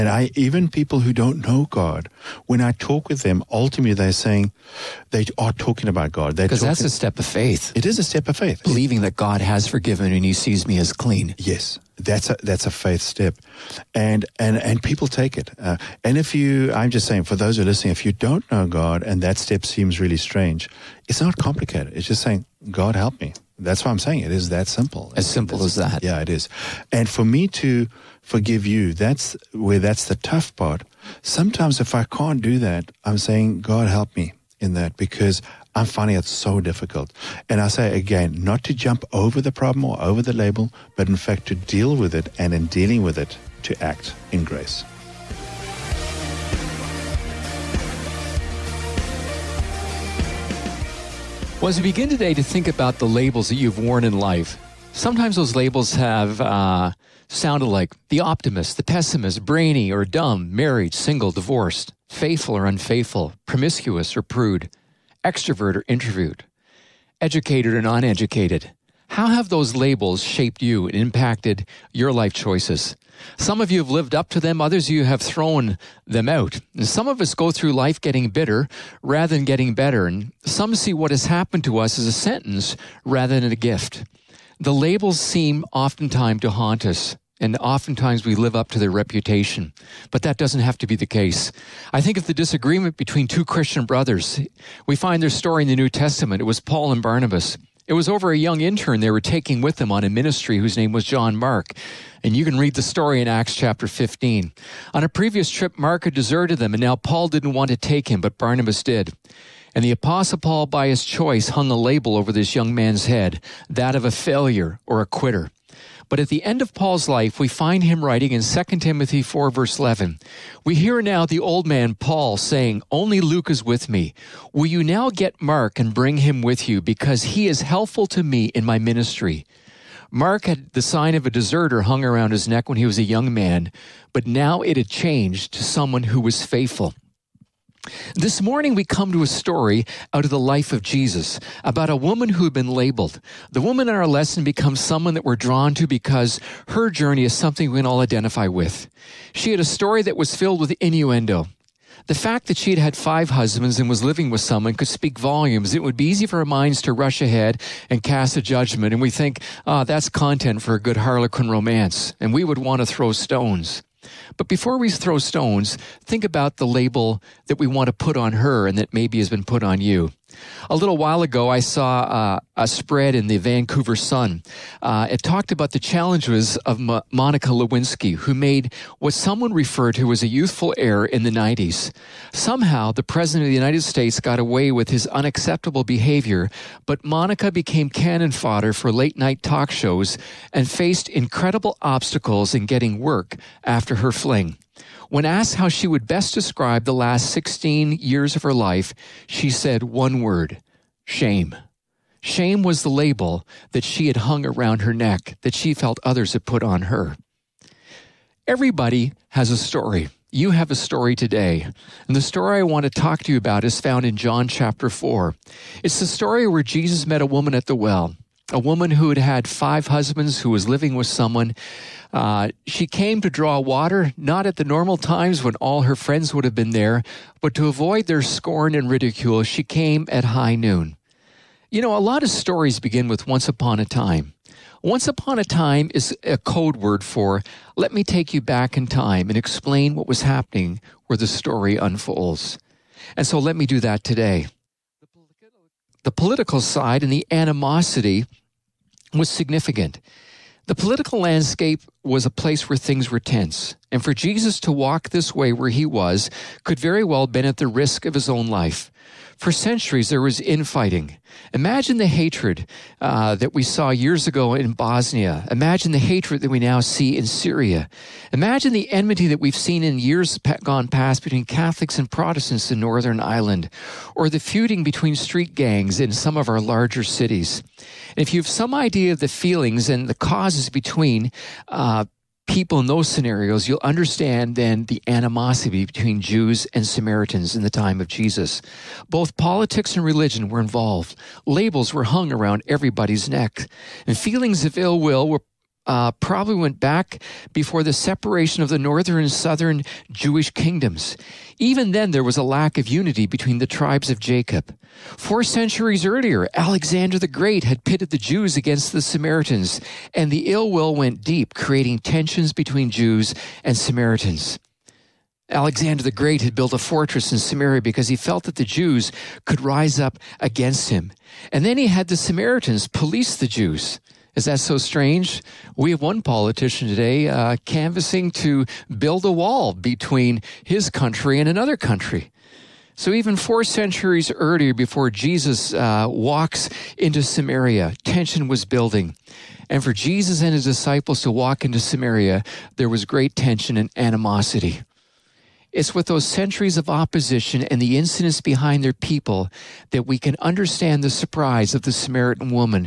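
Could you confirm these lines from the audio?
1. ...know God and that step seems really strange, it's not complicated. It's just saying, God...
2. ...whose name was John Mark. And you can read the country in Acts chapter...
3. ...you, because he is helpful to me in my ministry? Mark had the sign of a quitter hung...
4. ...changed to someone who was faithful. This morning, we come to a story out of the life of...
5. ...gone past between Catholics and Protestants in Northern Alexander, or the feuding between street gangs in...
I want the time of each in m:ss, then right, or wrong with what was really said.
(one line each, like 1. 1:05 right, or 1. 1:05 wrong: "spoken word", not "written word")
1. 0:18 right
2. 1:40 wrong: "story", not "country"
3. 2:06 wrong: "deserter", not "quitter"
4. 2:14 right
5. 4:30 wrong: "Ireland", not "Alexander".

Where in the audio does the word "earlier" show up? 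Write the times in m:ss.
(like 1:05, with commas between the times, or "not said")
5:06, 5:34.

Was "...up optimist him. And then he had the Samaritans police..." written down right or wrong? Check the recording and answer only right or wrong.
wrong.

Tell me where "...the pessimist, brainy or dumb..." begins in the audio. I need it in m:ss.
0:58.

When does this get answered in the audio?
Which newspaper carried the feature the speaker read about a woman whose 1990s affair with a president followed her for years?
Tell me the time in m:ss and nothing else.
2:53.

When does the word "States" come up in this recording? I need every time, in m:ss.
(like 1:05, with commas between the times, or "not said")
3:03.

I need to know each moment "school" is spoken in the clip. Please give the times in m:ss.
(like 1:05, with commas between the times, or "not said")
not said.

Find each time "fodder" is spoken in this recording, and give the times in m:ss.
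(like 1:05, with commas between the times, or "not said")
3:08.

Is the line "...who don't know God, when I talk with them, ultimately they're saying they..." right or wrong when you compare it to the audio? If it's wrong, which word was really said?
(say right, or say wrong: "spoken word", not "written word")
right.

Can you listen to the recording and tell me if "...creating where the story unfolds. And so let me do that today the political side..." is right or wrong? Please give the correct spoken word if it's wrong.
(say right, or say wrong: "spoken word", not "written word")
wrong: "happening", not "creating".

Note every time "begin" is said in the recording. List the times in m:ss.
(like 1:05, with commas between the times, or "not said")
0:51, 3:52.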